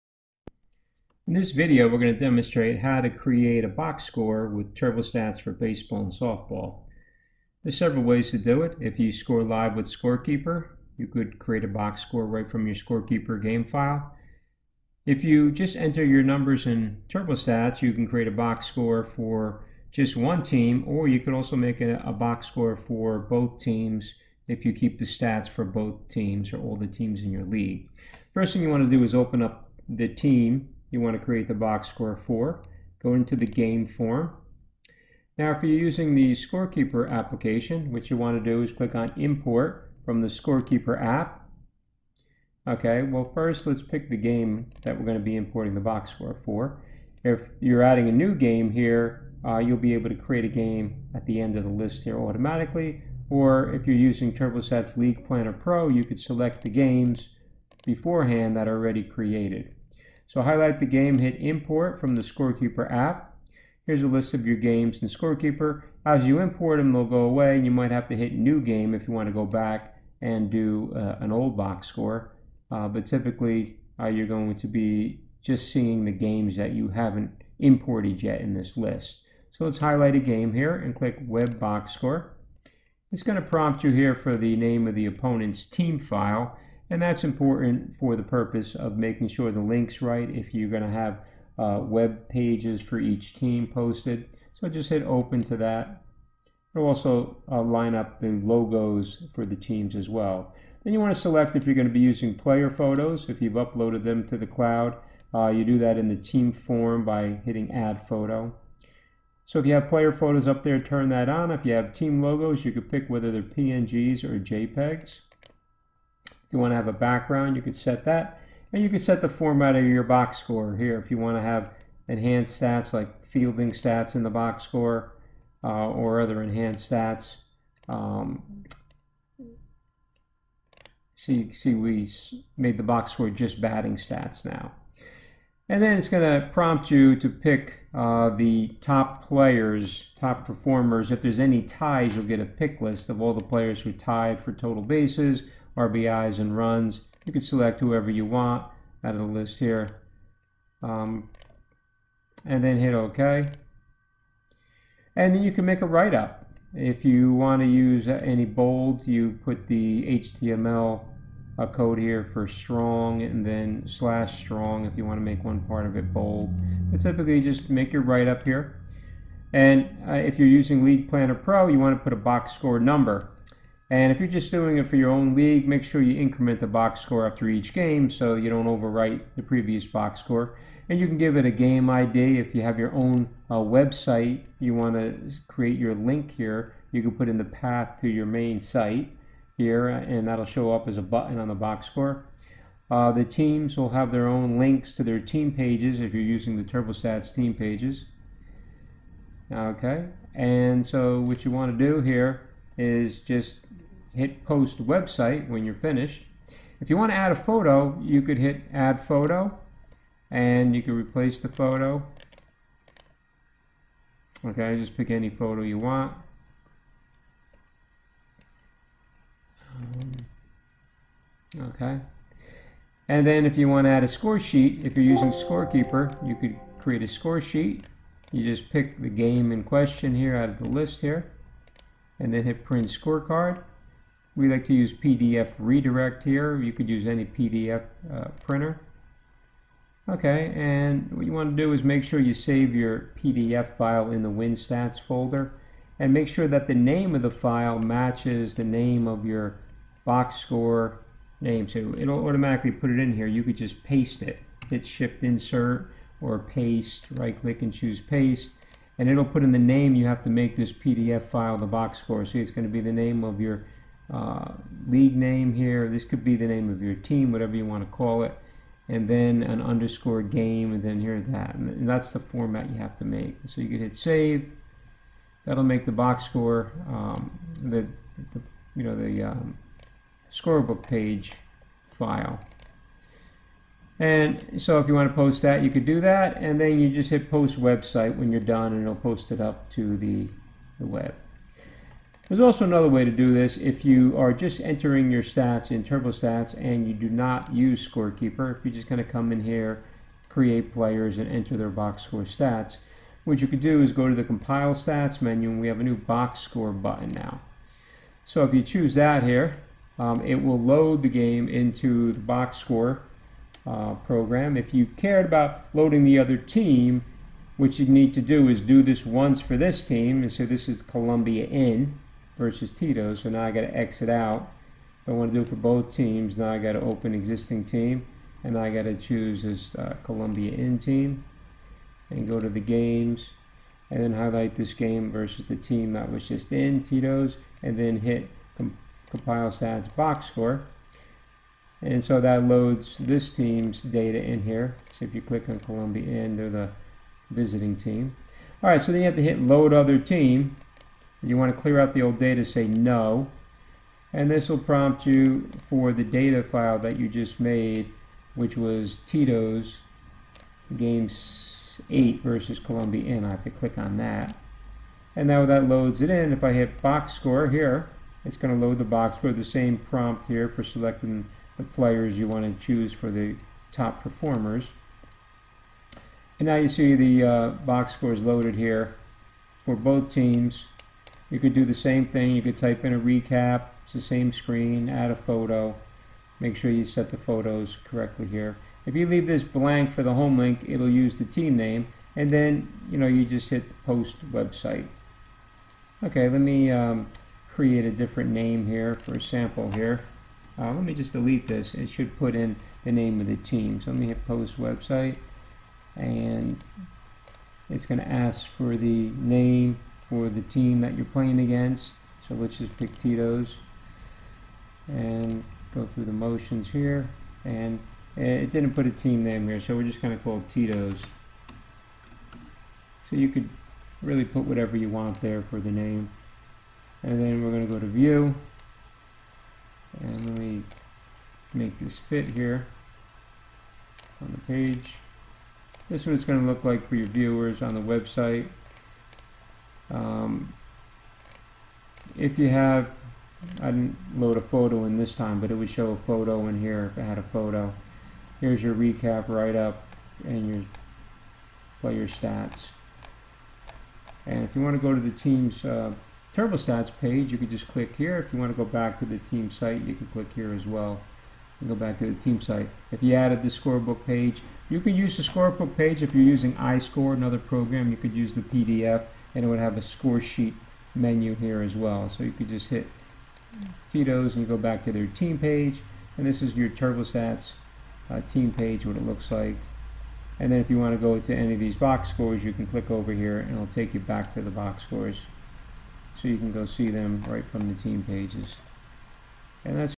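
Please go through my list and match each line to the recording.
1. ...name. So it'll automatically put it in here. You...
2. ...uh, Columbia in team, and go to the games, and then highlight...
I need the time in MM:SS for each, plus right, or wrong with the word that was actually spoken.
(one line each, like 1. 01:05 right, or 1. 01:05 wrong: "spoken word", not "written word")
1. 04:11 right
2. 05:29 right.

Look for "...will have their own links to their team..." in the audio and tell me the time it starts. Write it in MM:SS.
03:13.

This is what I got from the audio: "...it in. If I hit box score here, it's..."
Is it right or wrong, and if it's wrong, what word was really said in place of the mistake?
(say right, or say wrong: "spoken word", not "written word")
right.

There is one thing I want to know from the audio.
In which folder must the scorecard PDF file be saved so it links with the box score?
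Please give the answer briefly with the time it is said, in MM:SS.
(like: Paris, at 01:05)
WinStats, at 04:04.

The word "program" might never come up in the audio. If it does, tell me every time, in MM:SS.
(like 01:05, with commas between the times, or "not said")
05:13, 07:47.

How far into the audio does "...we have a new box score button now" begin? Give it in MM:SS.
05:05.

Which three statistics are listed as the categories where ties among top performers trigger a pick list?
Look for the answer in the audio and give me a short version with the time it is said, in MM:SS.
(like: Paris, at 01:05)
Total bases, RBIs and runs, at 02:24.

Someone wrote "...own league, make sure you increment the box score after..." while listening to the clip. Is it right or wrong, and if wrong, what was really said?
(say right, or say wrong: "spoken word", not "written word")
right.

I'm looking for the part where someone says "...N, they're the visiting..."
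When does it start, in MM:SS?
05:46.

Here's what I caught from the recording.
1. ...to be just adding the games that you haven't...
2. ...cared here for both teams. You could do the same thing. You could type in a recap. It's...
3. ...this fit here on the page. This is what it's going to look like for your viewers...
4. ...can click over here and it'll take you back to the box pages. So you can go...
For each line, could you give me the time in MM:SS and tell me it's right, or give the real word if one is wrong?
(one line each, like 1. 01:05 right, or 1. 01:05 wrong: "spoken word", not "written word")
1. 01:14 wrong: "seeing", not "adding"
2. 06:18 wrong: "loaded", not "cared"
3. 07:11 right
4. 08:02 wrong: "scores", not "pages".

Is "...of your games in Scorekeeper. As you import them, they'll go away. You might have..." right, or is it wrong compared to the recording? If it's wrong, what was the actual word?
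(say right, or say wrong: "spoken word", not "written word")
right.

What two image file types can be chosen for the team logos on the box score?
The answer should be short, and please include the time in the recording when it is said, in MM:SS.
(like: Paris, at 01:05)
PNGs or JPEGs, at 01:53.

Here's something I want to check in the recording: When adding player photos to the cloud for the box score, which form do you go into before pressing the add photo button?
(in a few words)
Team form.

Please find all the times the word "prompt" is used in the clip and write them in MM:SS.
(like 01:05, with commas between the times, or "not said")
01:23, 02:16, 05:54, 06:09.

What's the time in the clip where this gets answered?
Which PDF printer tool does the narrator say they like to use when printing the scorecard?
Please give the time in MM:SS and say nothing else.
03:54.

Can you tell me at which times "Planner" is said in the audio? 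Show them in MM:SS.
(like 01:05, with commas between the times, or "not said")
00:55, 02:51.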